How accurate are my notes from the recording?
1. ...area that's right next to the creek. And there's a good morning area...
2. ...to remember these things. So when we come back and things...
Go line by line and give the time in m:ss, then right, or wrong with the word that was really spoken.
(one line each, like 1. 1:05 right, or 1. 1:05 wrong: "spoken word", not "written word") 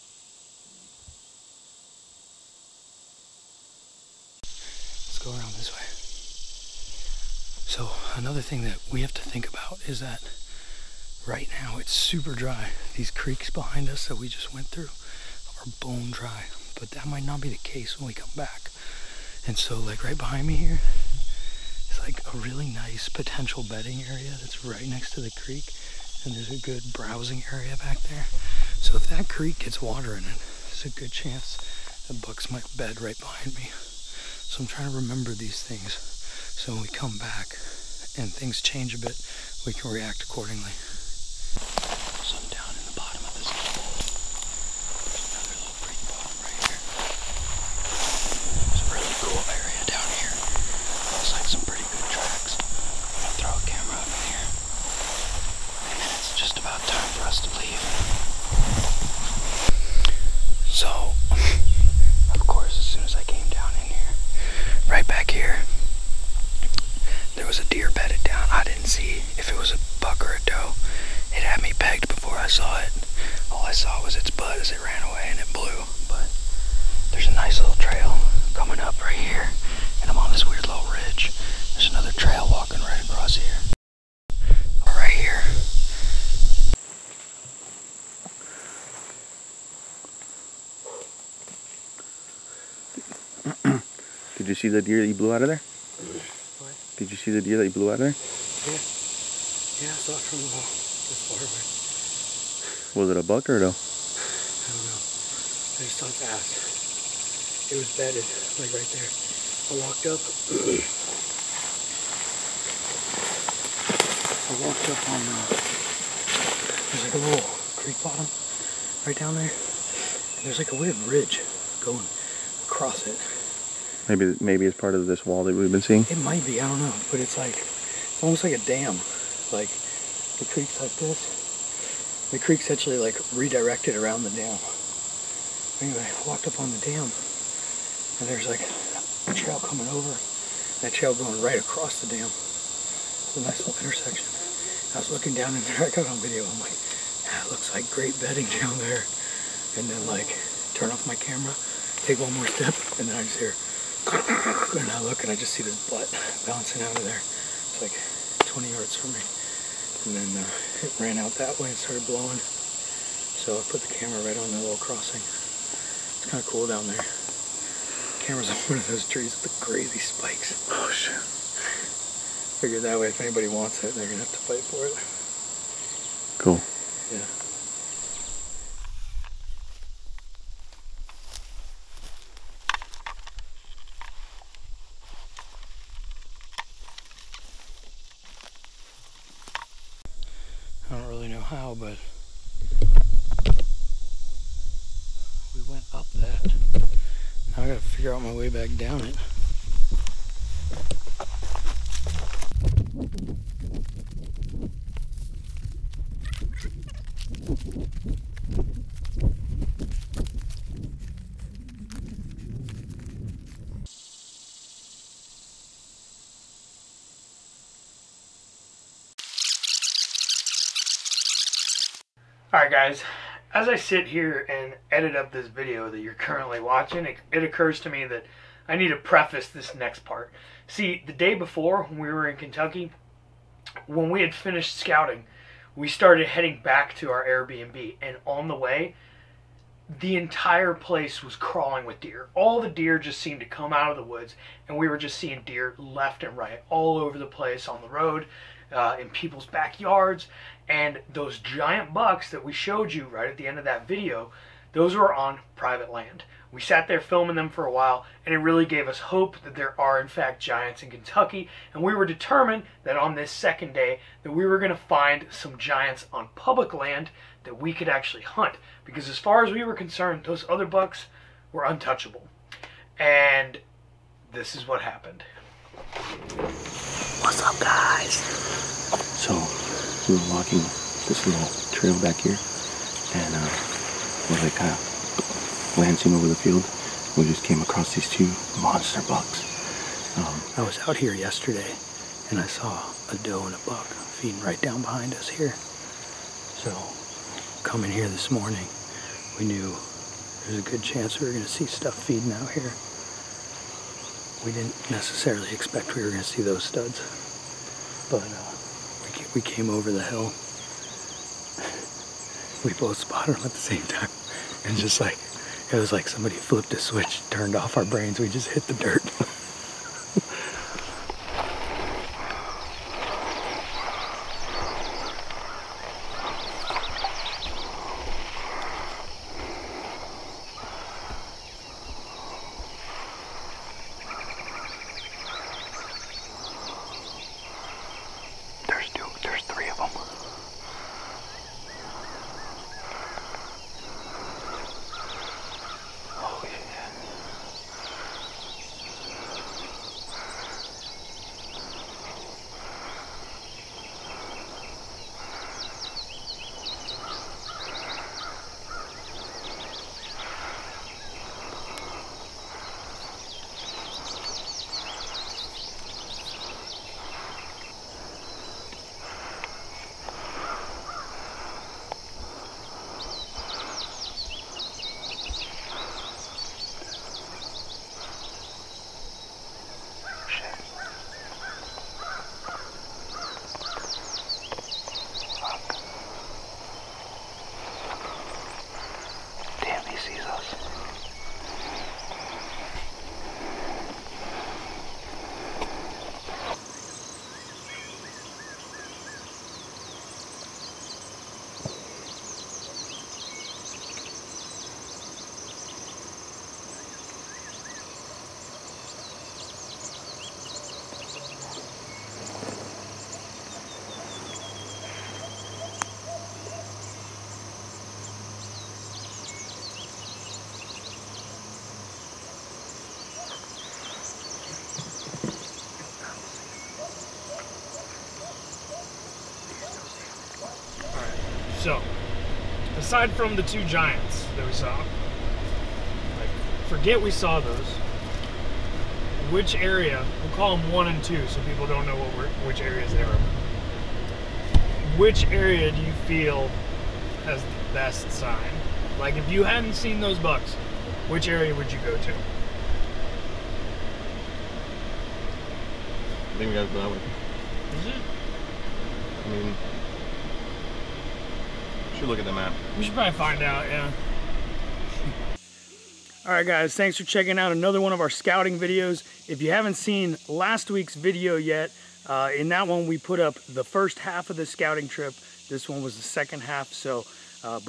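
1. 0:24 wrong: "browsing", not "morning"
2. 0:34 right.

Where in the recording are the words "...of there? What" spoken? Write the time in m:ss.
1:35.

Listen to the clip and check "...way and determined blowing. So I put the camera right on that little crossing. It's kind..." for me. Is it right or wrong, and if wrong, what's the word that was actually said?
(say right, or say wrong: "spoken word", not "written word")
wrong: "started", not "determined".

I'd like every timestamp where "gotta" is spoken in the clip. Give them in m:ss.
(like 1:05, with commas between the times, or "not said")
3:17, 7:36.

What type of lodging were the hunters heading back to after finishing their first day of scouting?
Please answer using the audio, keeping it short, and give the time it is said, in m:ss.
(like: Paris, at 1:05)
Airbnb, at 3:57.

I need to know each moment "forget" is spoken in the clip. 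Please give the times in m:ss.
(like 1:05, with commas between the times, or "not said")
7:16.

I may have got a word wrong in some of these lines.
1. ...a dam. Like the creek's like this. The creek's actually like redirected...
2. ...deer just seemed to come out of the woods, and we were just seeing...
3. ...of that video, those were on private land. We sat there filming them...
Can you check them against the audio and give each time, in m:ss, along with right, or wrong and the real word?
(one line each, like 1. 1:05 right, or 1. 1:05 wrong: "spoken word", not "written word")
1. 2:08 right
2. 4:02 right
3. 4:13 right.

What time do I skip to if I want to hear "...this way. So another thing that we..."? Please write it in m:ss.
0:05.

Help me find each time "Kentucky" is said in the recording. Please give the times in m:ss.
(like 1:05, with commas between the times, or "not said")
3:52, 4:20.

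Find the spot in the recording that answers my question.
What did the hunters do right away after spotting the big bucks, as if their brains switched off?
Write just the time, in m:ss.
5:18.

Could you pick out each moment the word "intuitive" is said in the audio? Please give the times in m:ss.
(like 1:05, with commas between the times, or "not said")
not said.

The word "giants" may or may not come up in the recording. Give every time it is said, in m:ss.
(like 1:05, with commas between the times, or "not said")
4:11, 4:20, 4:25, 7:13.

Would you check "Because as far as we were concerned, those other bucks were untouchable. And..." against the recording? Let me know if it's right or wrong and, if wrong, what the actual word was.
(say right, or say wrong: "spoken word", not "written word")
right.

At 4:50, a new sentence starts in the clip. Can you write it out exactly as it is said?
Um, I was out here yesterday, and I saw a doe and a buck feeding right down behind us here.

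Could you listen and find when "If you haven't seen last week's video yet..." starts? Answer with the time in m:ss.
7:49.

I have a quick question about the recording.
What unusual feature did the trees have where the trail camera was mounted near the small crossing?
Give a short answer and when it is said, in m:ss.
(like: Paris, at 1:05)
crazy spikes, at 2:49.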